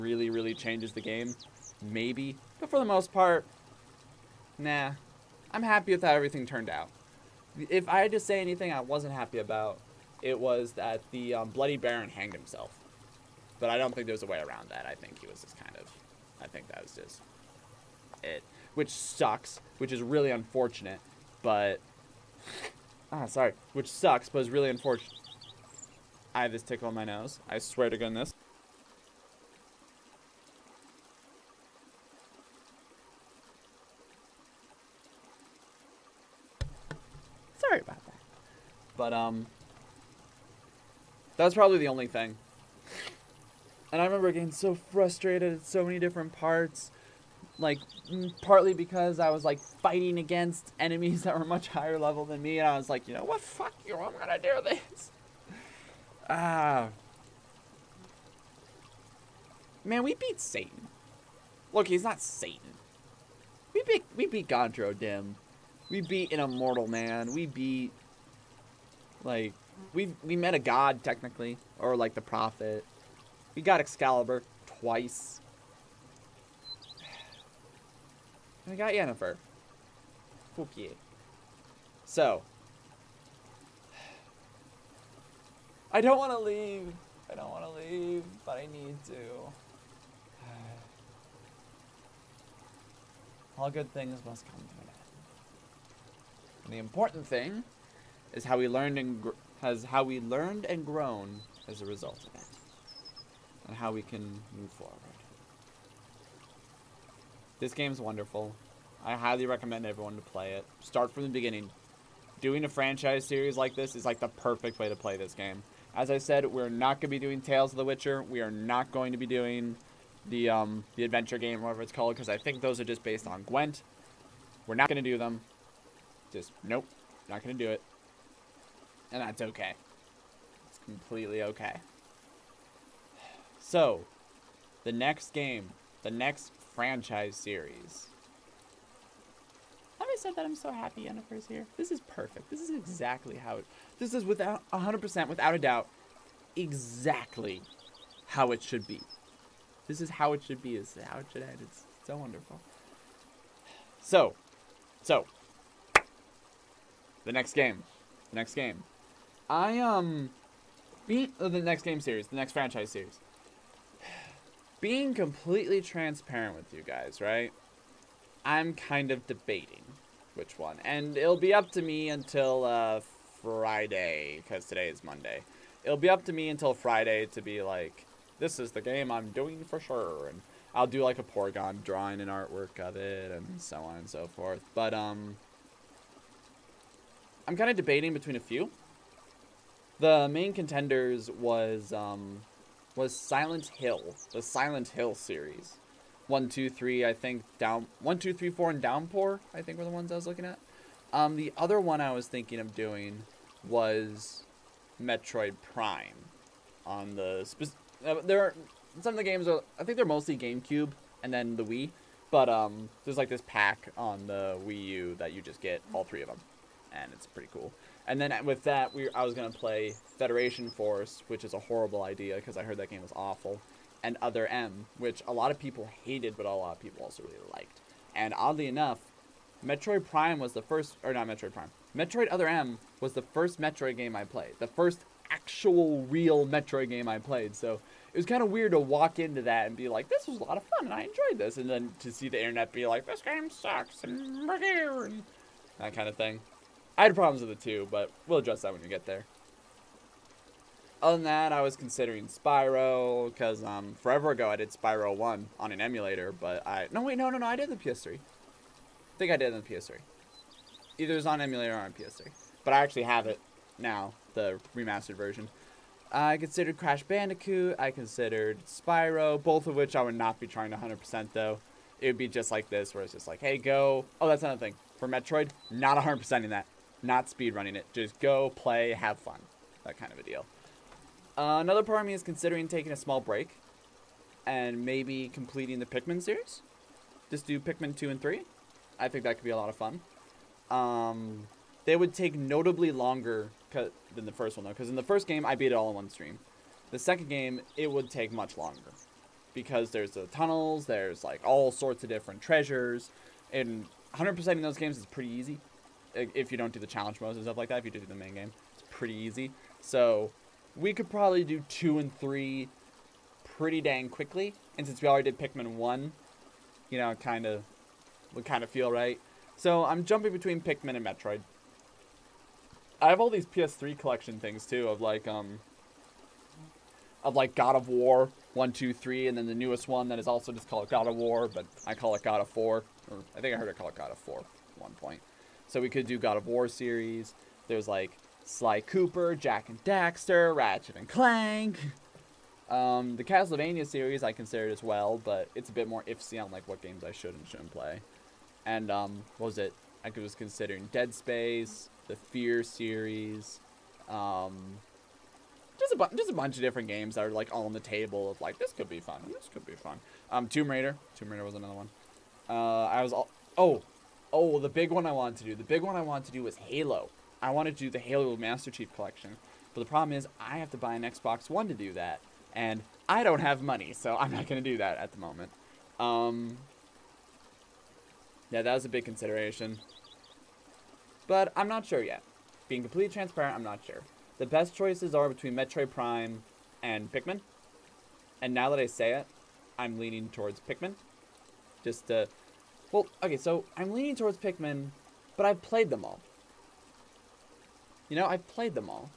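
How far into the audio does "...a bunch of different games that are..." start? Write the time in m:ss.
5:56.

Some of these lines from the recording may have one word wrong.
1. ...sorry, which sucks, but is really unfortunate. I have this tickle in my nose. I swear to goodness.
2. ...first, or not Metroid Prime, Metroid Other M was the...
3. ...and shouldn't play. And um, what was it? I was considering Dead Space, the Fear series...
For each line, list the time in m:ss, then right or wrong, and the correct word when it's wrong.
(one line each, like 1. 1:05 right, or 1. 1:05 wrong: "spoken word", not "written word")
1. 0:23 right
2. 3:50 right
3. 5:47 right.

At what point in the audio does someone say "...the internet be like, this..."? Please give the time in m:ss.
4:02.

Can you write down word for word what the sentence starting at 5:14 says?
And since we already did Pikmin 1, you know, kind of would kind of feel right.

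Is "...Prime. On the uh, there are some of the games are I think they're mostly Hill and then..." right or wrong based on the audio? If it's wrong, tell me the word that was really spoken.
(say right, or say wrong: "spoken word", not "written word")
wrong: "GameCube", not "Hill".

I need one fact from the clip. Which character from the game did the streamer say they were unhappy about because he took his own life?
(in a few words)
Bloody Baron.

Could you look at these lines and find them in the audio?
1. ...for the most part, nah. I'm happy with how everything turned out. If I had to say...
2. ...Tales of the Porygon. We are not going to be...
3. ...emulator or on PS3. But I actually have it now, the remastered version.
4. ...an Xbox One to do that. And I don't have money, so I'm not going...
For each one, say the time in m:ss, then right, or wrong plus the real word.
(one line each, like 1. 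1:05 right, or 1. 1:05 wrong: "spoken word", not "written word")
1. 0:02 right
2. 1:57 wrong: "Witcher", not "Porygon"
3. 4:21 right
4. 6:10 right.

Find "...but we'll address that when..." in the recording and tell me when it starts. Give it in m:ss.
4:07.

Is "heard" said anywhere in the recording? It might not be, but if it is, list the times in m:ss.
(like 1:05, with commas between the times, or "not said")
3:42, 5:33.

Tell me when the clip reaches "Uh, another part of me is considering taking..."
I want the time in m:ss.
4:41.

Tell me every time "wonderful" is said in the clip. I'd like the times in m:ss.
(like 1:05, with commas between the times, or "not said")
1:48, 2:32.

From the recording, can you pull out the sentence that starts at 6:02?
Uh, I was all oh Oh, well, the big one I wanted to do.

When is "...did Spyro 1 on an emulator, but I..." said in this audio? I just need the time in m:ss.
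4:14.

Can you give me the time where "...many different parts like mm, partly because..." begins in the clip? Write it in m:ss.
0:45.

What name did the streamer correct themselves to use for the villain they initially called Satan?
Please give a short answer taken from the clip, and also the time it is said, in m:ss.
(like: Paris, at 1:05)
Gaunter O'Dimm, at 1:04.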